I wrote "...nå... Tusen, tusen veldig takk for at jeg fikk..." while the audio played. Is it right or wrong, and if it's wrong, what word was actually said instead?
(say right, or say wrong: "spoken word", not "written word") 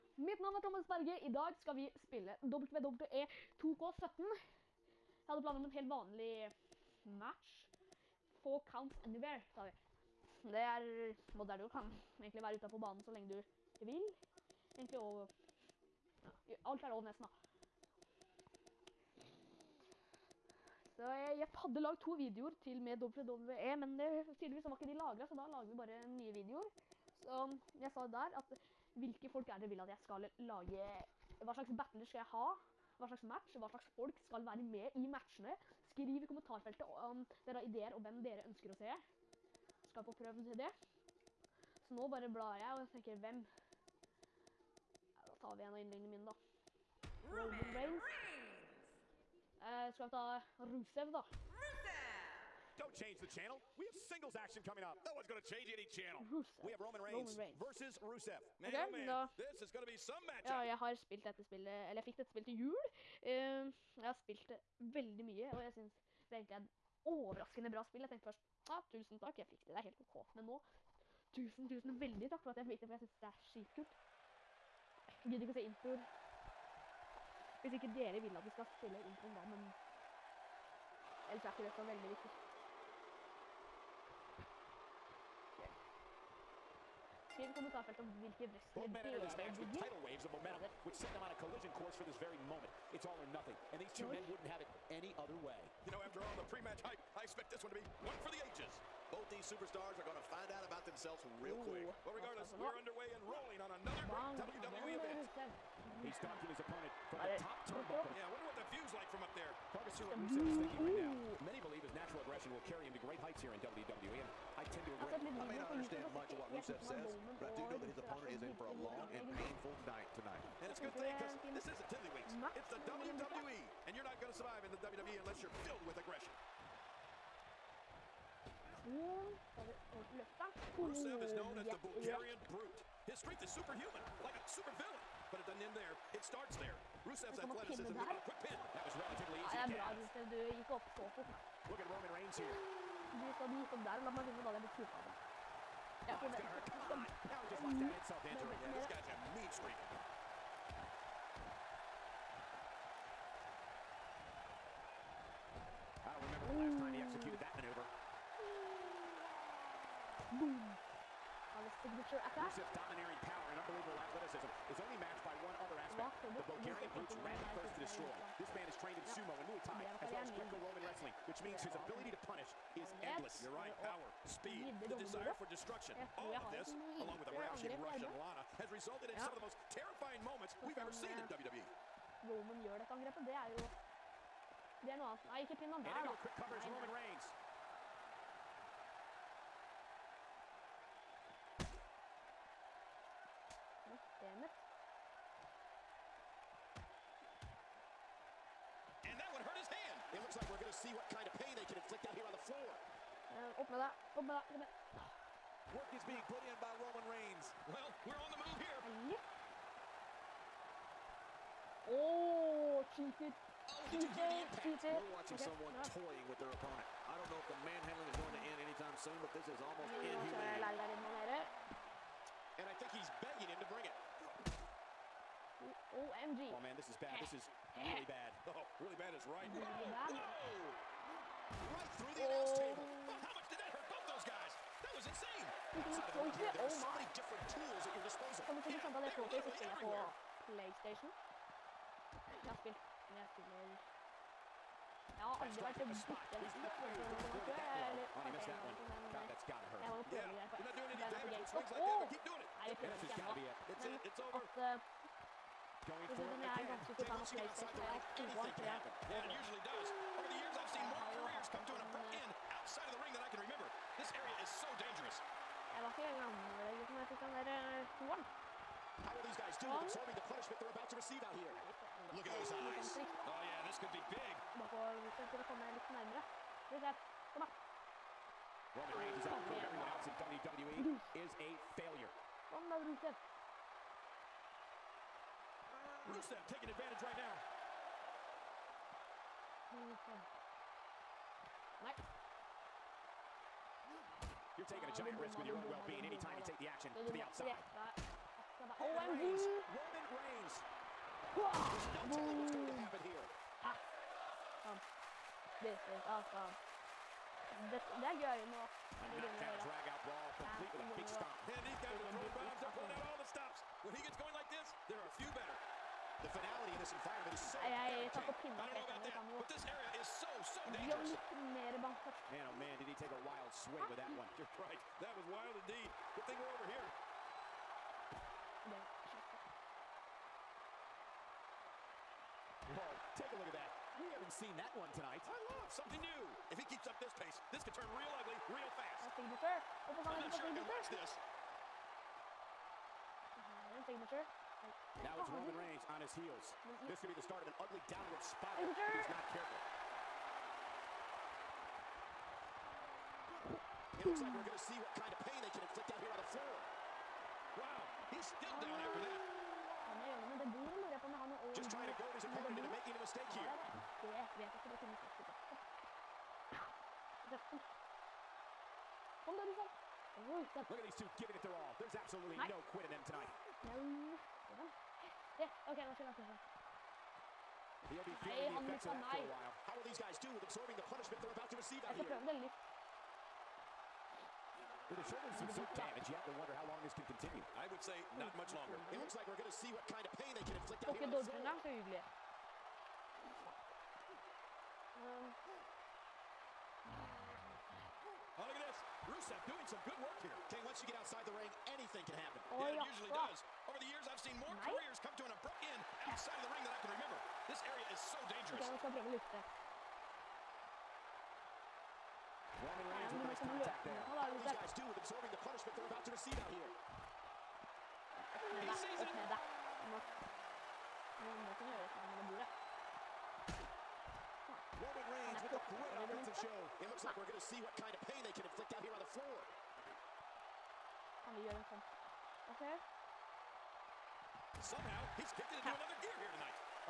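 right.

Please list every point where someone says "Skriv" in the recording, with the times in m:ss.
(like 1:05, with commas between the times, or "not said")
0:35, 1:27.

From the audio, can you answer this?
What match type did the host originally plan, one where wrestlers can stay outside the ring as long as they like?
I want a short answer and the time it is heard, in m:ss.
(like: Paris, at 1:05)
Counts Anywhere, at 0:08.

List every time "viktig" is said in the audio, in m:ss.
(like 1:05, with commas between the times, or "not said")
1:22.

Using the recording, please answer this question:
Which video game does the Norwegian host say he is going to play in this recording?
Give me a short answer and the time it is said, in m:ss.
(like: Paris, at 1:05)
WWE 2K17, at 0:02.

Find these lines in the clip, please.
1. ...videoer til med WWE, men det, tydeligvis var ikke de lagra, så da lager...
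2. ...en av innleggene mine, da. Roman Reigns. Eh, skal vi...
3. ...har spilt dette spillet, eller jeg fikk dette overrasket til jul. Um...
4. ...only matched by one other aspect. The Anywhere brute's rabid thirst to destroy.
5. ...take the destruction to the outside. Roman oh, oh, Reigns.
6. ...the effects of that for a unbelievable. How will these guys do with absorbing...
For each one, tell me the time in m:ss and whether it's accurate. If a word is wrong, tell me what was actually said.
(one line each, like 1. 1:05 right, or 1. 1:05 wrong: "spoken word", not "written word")
1. 0:22 right
2. 0:45 right
3. 1:00 wrong: "spillet", not "overrasket"
4. 2:44 wrong: "Bulgarian", not "Anywhere"
5. 4:56 wrong: "action", not "destruction"
6. 6:18 wrong: "while", not "unbelievable".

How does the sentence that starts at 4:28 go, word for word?
Eh, How will these guys do with absorbing the punishment they're about to receive out here?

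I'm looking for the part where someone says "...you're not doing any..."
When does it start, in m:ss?
4:10.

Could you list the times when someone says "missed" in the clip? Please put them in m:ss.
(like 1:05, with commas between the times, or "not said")
4:08.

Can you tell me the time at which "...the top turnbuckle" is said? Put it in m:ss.
1:47.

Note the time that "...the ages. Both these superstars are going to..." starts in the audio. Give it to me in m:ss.
1:38.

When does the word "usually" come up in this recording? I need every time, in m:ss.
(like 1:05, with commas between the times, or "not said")
4:19, 6:42.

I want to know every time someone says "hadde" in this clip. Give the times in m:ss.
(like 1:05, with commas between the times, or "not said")
0:05, 0:21, 2:24.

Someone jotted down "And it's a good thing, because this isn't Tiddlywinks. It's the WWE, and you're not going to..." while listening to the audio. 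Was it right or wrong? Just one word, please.
right.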